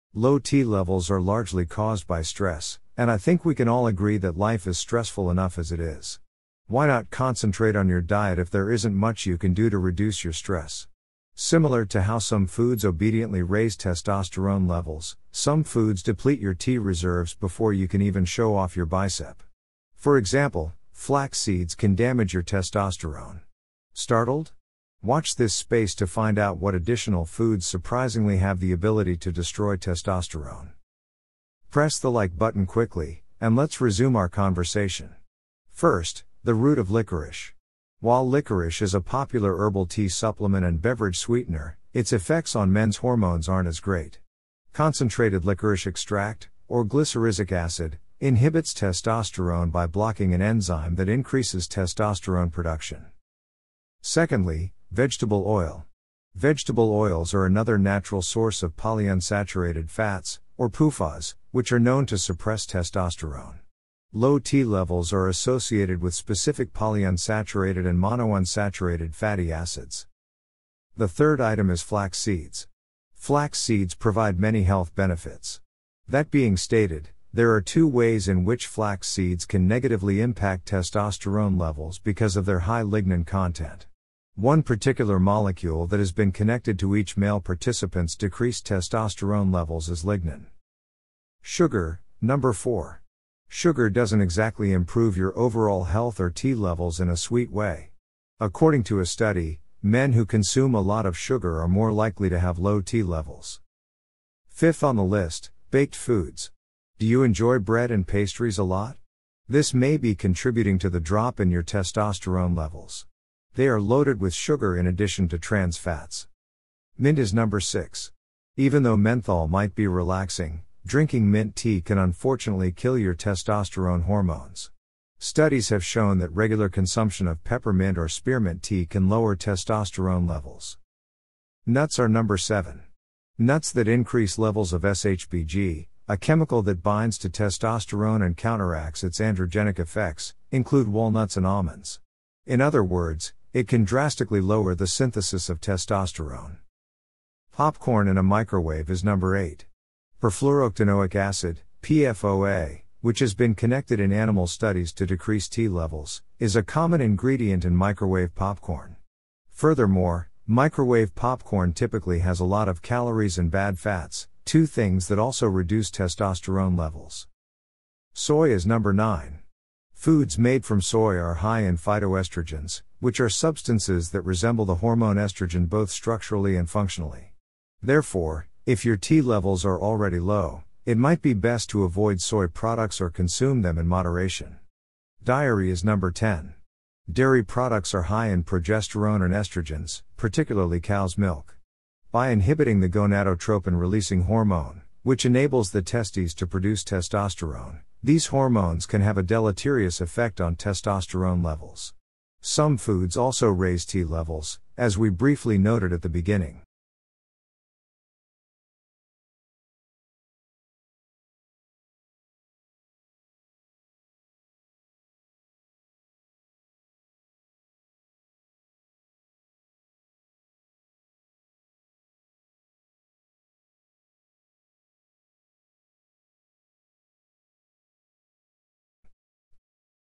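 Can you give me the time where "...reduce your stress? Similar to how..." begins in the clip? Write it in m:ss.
0:09.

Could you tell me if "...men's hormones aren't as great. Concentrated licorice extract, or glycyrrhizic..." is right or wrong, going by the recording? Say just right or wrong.
right.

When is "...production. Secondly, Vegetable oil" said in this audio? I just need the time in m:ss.
0:52.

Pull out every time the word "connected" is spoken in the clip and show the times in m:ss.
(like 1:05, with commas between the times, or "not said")
1:26, 2:33.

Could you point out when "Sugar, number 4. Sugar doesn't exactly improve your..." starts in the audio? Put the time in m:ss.
1:31.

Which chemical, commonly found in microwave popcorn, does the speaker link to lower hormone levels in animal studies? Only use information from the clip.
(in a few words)
Perfluorooctanoic acid (PFOA).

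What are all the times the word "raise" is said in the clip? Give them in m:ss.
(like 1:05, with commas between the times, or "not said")
0:13, 3:23.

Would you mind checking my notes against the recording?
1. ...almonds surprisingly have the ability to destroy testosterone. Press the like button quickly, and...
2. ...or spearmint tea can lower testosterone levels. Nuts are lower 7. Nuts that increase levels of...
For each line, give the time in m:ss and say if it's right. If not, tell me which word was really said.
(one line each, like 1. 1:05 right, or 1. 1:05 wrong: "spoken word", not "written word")
1. 0:27 wrong: "foods", not "almonds"
2. 2:07 wrong: "number", not "lower".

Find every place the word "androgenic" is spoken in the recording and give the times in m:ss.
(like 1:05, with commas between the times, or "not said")
2:19.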